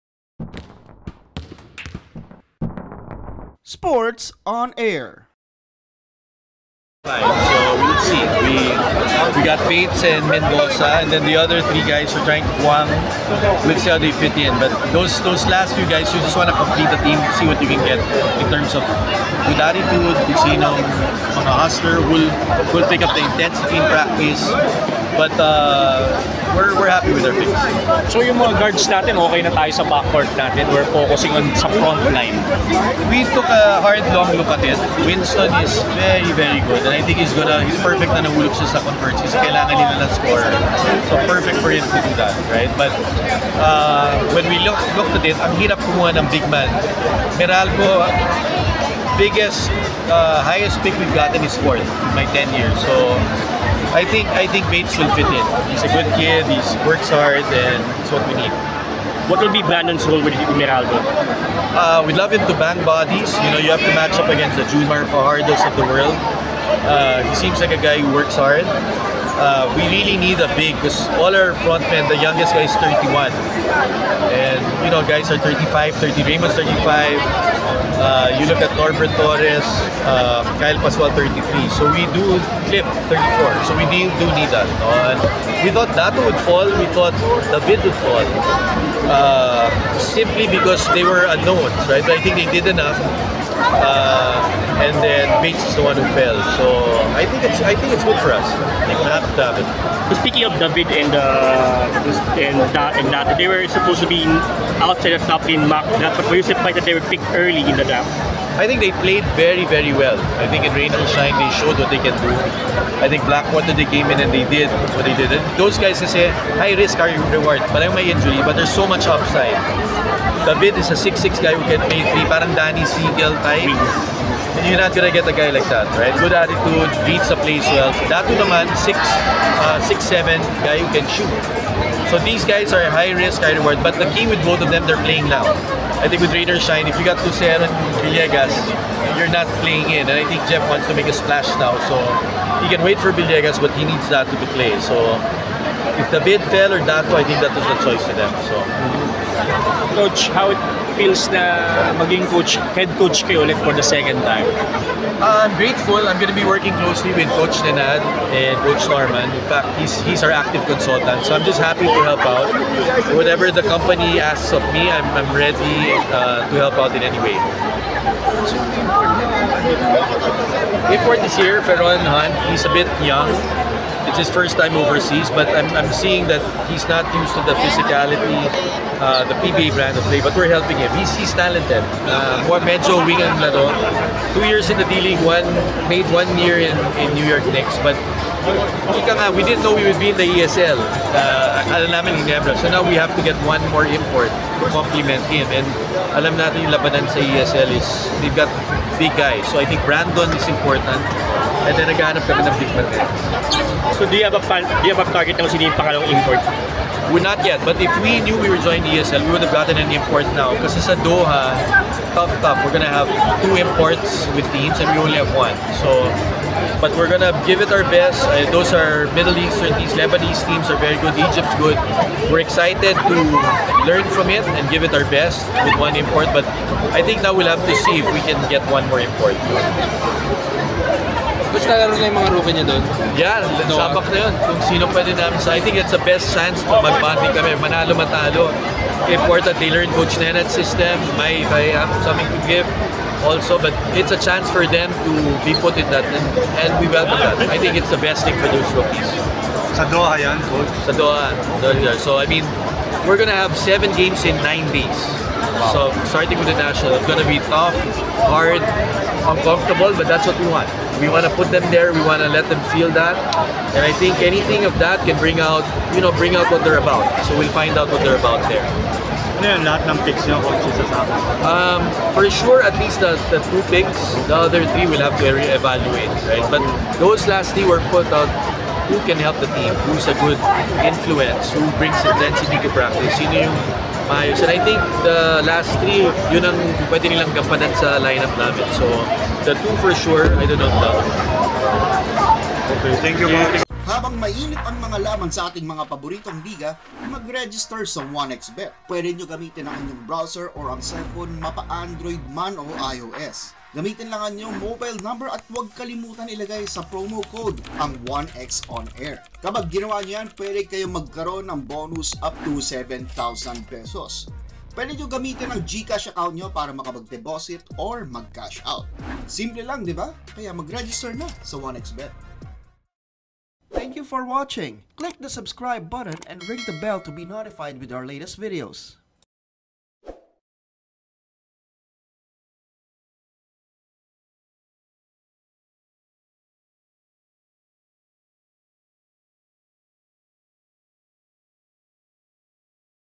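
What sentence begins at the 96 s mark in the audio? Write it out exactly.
So think it's I think it's good for us.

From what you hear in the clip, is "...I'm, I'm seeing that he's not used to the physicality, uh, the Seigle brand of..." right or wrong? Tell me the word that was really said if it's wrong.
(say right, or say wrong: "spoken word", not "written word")
wrong: "PBA", not "Seigle".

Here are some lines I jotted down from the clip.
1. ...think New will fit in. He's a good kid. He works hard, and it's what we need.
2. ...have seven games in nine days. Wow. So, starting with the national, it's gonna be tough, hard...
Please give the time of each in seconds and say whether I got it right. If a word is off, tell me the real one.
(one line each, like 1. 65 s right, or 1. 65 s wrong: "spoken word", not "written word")
1. 54 s wrong: "Bates", not "New"
2. 253 s right.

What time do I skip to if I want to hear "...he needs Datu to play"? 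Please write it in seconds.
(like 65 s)
143 s.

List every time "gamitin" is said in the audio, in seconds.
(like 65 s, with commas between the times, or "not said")
299 s, 303 s, 315 s.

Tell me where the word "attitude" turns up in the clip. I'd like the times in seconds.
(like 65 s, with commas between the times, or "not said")
19 s, 126 s.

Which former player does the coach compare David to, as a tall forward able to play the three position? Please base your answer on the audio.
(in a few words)
Danny Seigle.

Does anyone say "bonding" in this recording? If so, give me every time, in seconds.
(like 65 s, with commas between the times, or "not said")
236 s.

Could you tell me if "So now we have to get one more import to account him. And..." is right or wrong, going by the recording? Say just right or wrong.
wrong.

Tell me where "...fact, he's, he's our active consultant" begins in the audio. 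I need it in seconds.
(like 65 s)
159 s.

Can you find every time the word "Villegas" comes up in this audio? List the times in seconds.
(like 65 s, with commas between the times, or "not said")
138 s, 143 s.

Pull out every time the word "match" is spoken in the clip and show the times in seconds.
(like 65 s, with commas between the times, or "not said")
63 s.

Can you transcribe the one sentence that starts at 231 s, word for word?
Coach, nalaro na yung mga rookie niya doon?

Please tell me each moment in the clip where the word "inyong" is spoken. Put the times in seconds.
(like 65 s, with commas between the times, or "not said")
299 s, 304 s.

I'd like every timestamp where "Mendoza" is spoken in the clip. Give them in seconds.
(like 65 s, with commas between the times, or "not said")
10 s.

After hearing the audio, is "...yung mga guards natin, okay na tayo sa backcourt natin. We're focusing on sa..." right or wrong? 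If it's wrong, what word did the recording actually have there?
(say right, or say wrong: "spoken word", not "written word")
right.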